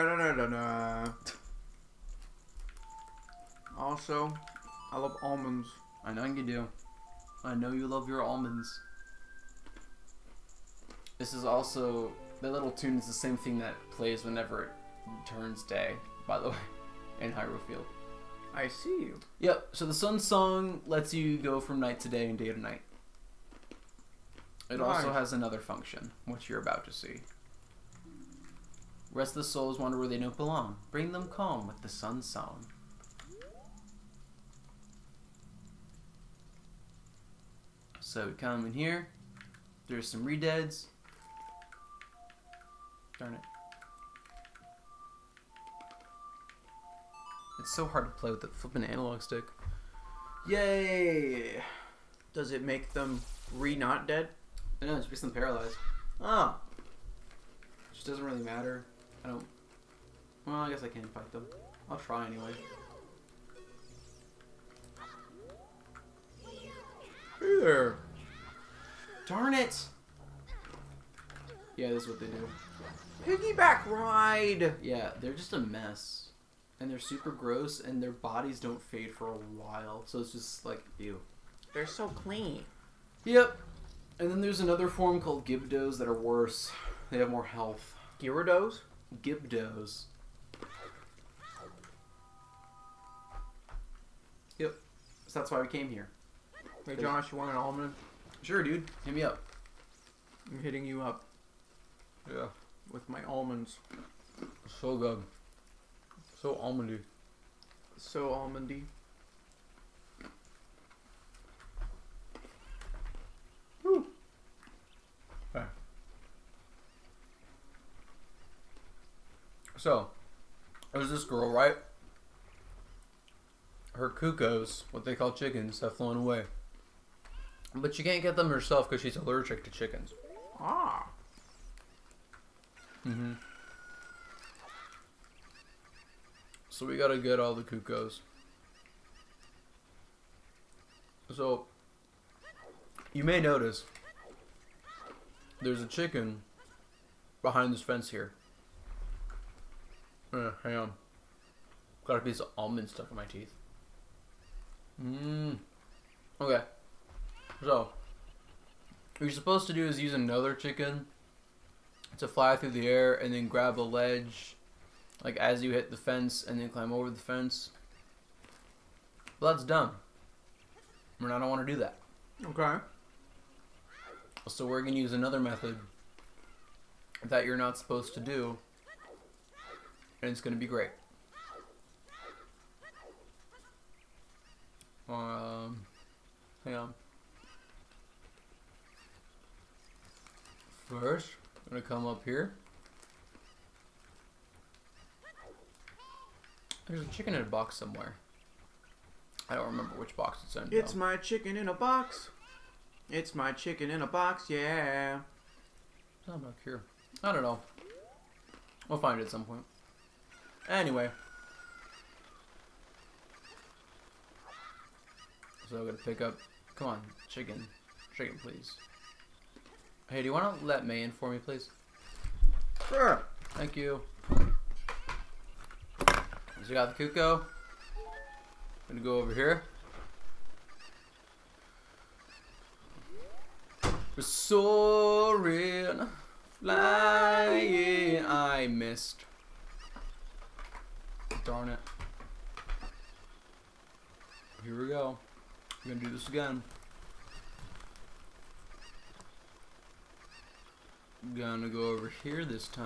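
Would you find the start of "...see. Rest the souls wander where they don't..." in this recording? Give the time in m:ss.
0:26.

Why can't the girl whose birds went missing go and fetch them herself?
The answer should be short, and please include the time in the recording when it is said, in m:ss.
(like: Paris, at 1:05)
Allergic to chickens, at 2:09.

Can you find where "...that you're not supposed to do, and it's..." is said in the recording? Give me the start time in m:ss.
2:57.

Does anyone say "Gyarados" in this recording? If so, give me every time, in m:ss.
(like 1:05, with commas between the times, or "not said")
1:28.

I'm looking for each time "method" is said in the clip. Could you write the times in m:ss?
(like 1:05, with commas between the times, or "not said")
2:55.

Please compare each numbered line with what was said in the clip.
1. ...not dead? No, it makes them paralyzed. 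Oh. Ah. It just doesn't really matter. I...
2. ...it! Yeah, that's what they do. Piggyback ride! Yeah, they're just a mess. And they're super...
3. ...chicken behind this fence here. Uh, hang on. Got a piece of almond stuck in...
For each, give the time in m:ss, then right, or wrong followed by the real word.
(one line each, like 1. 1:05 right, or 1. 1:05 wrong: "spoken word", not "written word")
1. 0:53 right
2. 1:09 right
3. 2:25 right.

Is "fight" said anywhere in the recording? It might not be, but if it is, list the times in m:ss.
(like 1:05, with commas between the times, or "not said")
1:01.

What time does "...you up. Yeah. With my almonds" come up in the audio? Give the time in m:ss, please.
1:40.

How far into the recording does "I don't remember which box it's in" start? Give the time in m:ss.
3:19.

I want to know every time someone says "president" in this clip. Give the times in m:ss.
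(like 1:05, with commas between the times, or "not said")
not said.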